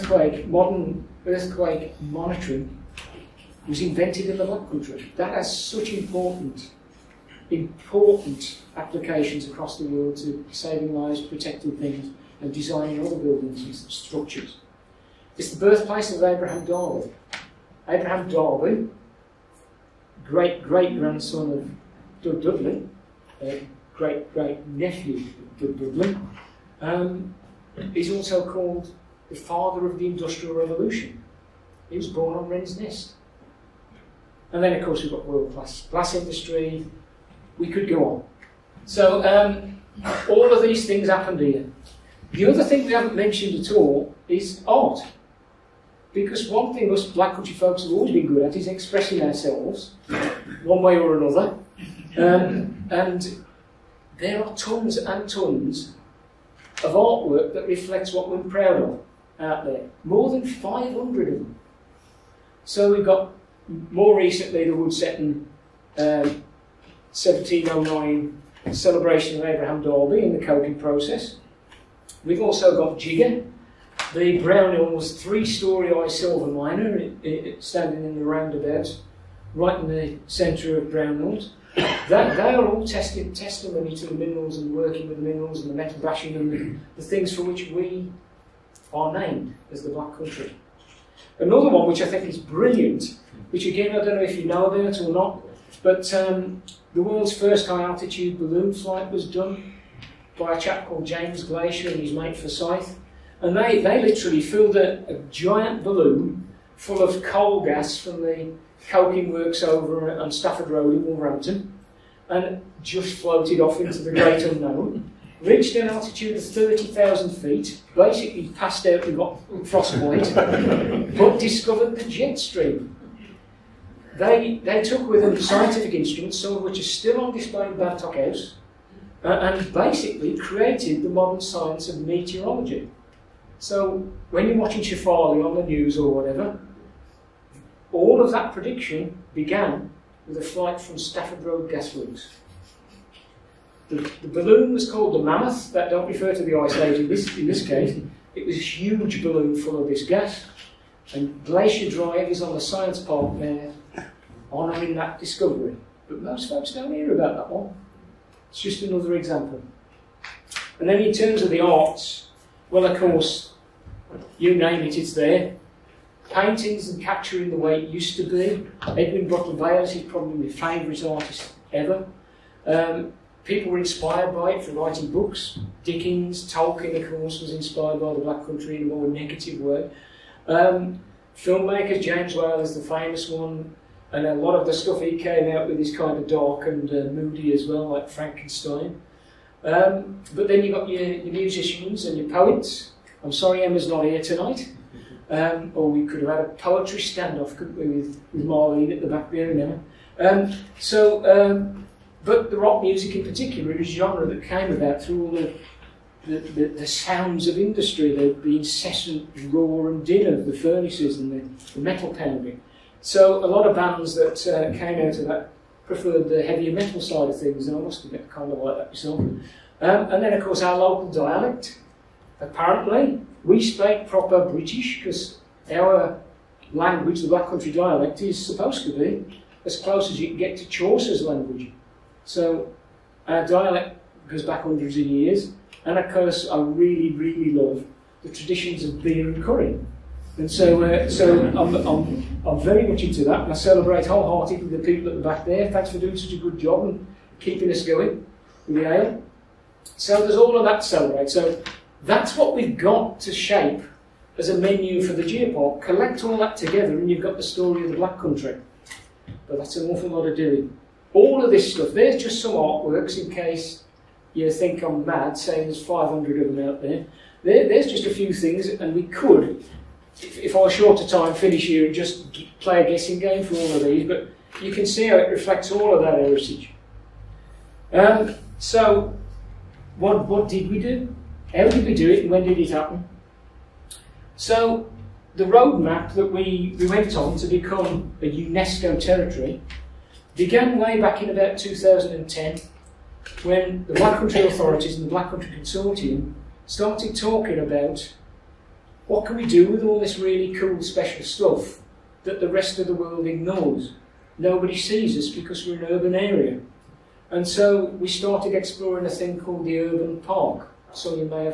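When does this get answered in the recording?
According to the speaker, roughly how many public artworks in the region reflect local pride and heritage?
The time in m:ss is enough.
1:00.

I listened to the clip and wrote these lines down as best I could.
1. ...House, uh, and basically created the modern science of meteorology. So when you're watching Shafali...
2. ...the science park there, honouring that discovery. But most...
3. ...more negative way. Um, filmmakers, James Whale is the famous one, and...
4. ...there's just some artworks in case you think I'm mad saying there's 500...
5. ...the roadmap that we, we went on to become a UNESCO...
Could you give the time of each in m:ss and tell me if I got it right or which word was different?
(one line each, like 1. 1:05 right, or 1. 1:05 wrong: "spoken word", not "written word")
1. 2:08 right
2. 2:32 right
3. 2:58 right
4. 4:21 right
5. 4:45 right.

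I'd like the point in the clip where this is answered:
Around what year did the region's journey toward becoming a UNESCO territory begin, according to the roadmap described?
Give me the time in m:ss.
4:51.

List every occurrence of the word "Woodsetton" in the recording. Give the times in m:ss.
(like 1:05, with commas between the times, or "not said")
1:04.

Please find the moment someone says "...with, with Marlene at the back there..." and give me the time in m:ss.
3:17.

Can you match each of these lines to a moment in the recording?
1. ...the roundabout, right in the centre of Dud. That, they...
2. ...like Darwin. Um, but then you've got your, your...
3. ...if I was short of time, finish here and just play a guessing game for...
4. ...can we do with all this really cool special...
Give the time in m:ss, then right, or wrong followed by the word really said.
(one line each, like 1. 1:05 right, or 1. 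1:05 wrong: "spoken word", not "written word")
1. 1:18 wrong: "Brownhills", not "Dud"
2. 3:07 wrong: "Frankenstein", not "Darwin"
3. 4:30 right
4. 4:59 right.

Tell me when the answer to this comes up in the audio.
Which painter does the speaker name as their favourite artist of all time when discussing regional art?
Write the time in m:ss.
2:48.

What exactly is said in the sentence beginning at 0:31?
He was born on Wren's Nest.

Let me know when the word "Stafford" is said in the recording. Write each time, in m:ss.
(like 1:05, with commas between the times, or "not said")
1:50, 2:20.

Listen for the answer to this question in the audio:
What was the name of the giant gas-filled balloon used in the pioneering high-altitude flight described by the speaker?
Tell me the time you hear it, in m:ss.
2:25.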